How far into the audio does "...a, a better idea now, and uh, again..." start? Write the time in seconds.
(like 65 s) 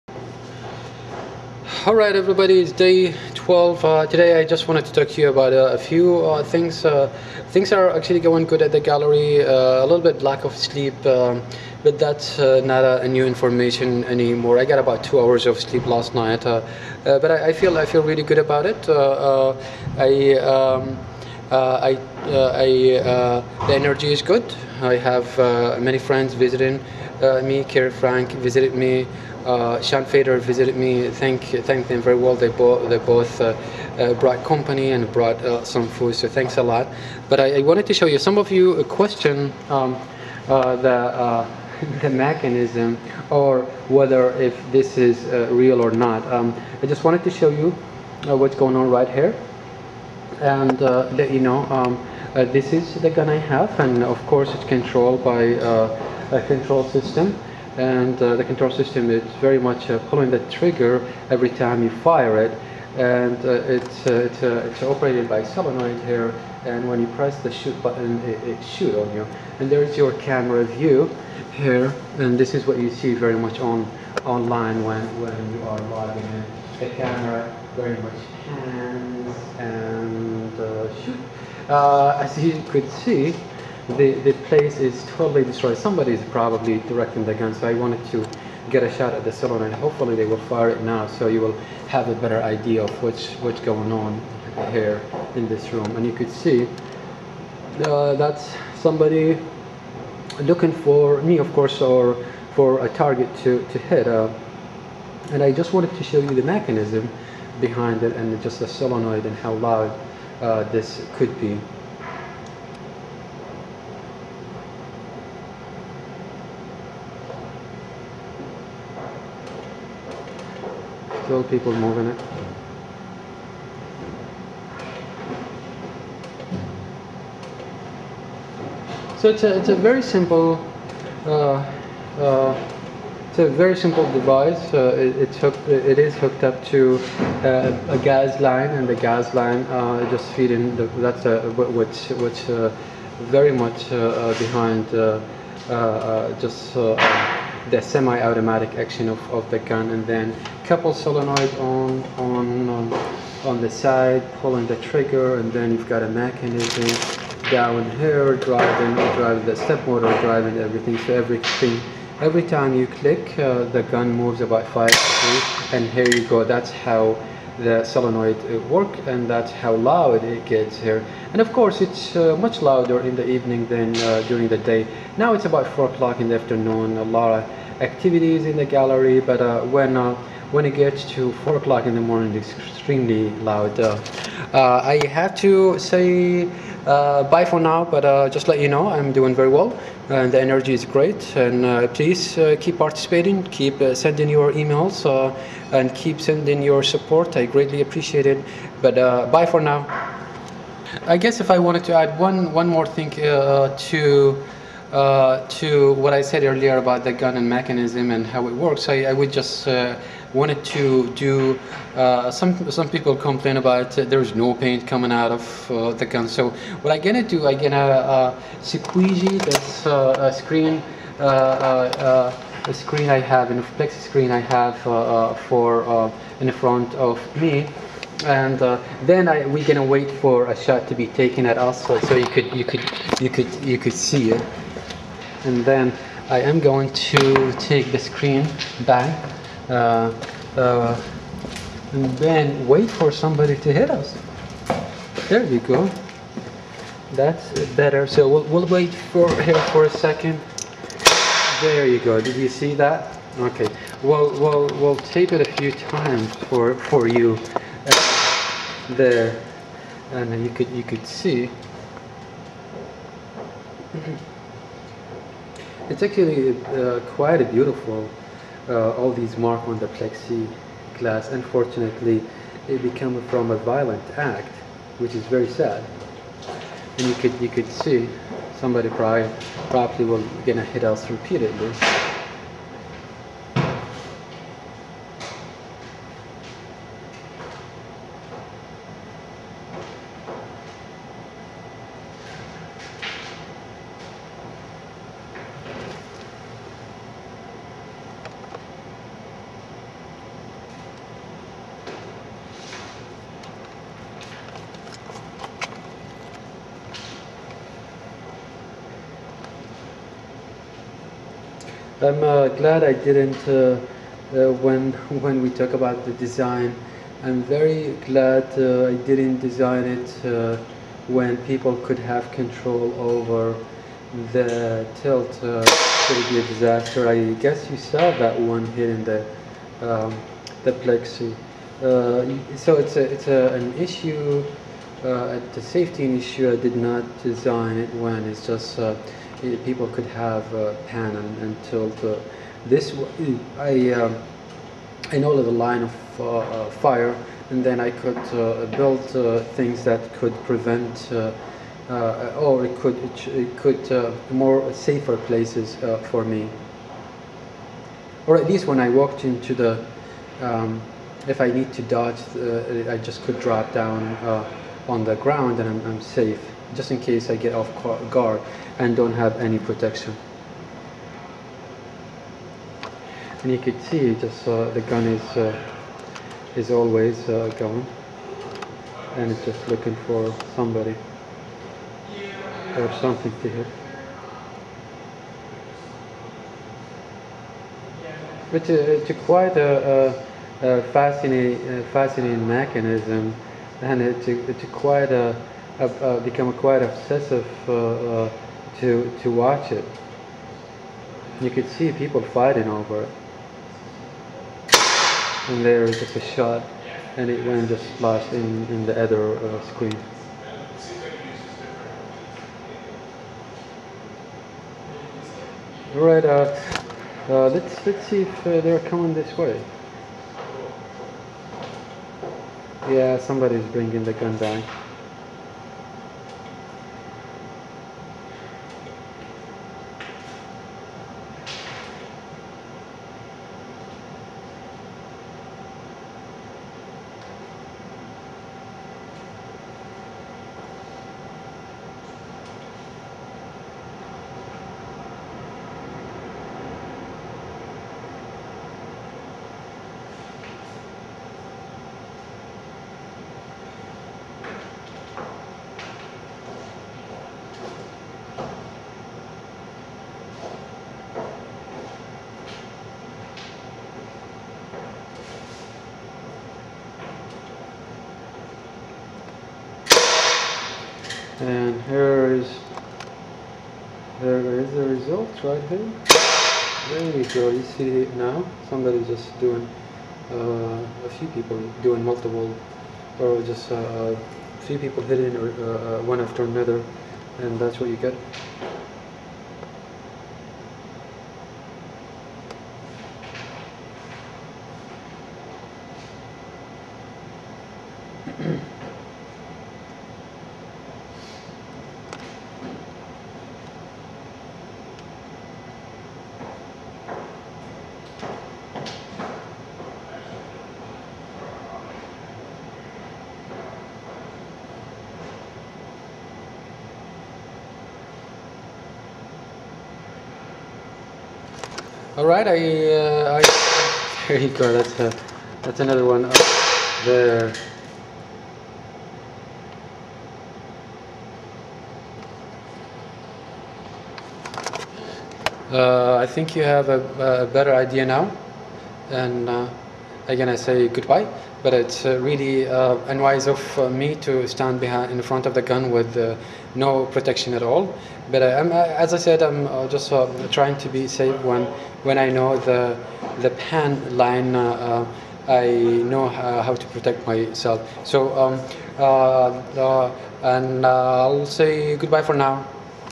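536 s.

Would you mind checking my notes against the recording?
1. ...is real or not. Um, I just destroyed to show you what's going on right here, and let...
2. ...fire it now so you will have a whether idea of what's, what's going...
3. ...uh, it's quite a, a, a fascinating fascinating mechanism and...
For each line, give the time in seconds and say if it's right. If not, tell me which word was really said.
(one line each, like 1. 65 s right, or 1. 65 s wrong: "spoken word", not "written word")
1. 44 s wrong: "wanted", not "destroyed"
2. 90 s wrong: "better", not "whether"
3. 388 s right.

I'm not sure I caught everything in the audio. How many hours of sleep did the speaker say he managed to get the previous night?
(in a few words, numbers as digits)
2.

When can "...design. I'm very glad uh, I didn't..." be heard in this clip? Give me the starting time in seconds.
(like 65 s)
316 s.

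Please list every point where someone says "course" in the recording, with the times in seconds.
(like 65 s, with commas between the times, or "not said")
54 s, 101 s, 171 s.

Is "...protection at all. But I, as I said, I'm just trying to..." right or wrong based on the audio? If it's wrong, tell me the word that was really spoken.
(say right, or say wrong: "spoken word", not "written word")
right.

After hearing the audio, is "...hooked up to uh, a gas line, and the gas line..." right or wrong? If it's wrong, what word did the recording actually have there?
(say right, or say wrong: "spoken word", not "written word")
right.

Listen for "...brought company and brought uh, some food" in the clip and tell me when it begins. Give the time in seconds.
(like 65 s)
34 s.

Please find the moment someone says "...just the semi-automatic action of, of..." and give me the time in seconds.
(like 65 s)
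146 s.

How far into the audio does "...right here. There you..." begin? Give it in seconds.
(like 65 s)
475 s.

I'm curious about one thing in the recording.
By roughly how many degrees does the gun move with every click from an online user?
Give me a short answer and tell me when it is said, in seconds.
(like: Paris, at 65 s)
5, at 164 s.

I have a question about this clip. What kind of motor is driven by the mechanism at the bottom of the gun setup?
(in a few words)
Step motor.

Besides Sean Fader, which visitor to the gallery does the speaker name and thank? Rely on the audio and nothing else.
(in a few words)
Kerry Frank.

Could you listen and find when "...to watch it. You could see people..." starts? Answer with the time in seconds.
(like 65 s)
399 s.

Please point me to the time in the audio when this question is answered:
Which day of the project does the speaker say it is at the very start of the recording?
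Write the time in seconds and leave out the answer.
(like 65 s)
2 s.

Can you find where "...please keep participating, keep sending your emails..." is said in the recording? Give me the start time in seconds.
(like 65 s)
191 s.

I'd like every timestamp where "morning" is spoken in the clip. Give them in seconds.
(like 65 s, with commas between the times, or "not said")
182 s.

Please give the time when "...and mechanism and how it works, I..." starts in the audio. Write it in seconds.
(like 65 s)
207 s.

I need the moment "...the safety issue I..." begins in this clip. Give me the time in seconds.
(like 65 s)
335 s.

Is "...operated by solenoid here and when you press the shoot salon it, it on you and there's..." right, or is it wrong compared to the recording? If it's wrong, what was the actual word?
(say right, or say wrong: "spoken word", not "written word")
wrong: "button", not "salon".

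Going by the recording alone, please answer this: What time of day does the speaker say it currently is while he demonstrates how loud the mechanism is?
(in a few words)
4 pm.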